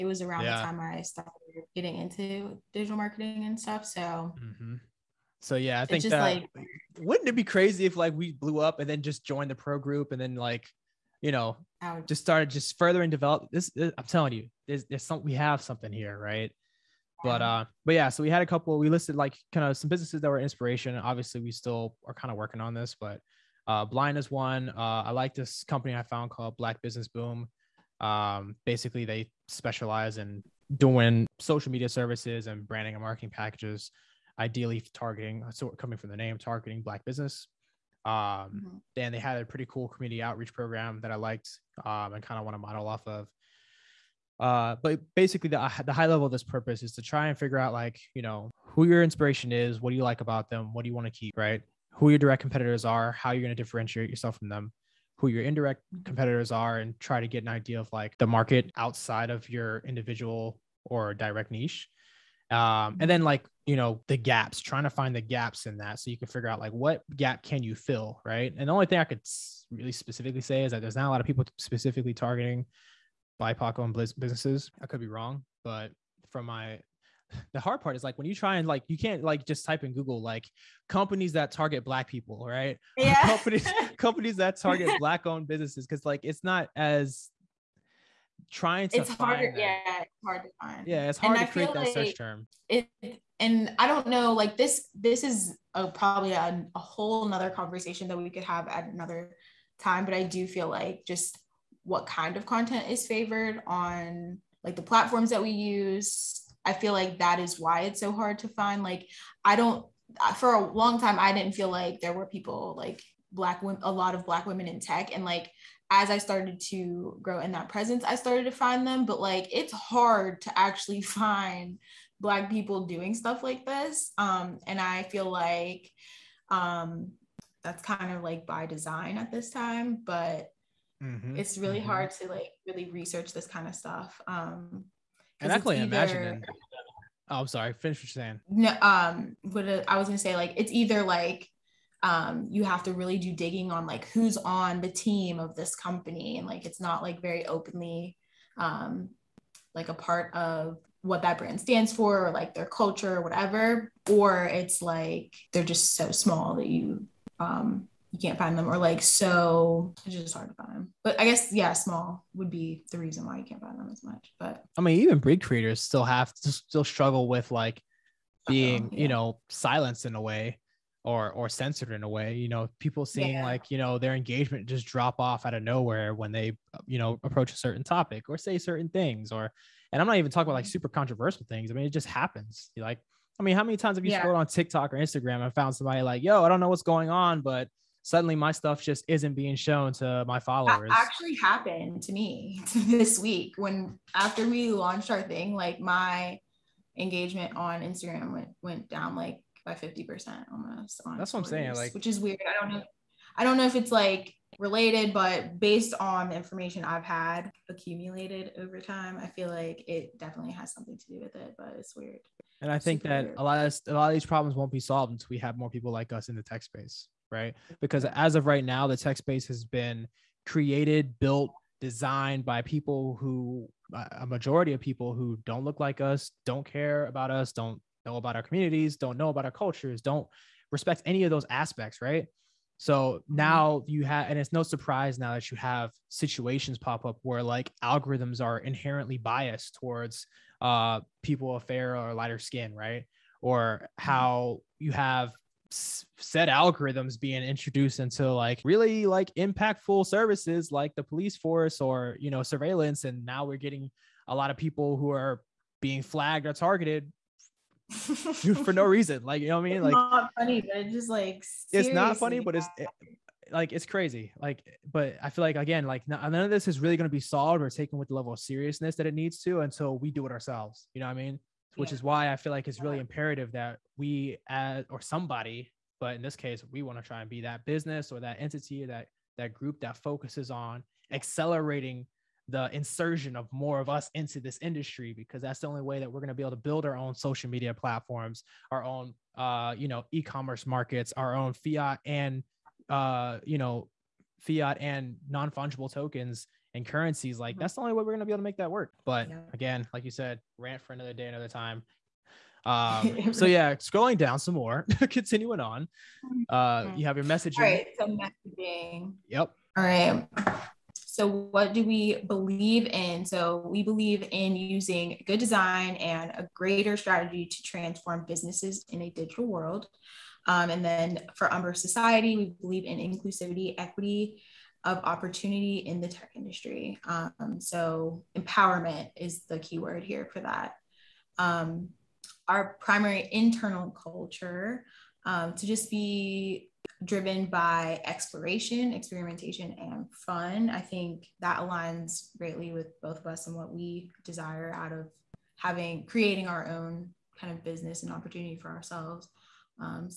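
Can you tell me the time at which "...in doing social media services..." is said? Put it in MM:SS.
00:30.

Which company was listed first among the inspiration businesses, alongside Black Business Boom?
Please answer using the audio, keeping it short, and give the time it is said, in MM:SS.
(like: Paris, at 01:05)
Blind, at 00:23.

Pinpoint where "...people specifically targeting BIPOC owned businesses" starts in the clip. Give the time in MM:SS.
01:11.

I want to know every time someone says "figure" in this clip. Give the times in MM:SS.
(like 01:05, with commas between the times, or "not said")
00:47, 01:06.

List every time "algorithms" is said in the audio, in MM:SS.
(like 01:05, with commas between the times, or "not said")
03:57, 04:06.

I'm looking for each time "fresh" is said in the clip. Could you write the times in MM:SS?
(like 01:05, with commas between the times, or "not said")
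not said.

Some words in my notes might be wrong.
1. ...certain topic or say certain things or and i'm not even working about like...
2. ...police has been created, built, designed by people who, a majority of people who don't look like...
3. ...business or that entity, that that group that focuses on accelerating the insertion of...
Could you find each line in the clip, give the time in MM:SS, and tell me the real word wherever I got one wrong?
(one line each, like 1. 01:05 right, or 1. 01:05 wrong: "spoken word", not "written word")
1. 02:57 wrong: "talking", not "working"
2. 03:39 wrong: "space", not "police"
3. 04:37 right.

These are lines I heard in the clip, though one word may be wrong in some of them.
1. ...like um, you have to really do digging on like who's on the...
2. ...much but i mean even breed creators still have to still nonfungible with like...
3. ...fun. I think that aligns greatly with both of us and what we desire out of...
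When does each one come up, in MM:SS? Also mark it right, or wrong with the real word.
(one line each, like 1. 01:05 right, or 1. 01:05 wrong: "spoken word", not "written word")
1. 02:21 right
2. 02:44 wrong: "struggle", not "nonfungible"
3. 05:40 right.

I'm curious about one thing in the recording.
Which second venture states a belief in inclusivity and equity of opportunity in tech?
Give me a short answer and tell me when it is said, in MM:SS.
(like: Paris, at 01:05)
Umber Society, at 05:21.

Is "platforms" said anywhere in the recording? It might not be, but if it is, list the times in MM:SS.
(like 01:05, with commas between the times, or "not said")
01:44, 04:47.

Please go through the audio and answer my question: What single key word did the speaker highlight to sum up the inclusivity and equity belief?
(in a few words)
Empowerment.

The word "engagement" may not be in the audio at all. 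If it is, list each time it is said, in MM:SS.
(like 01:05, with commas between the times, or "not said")
02:54, 03:16.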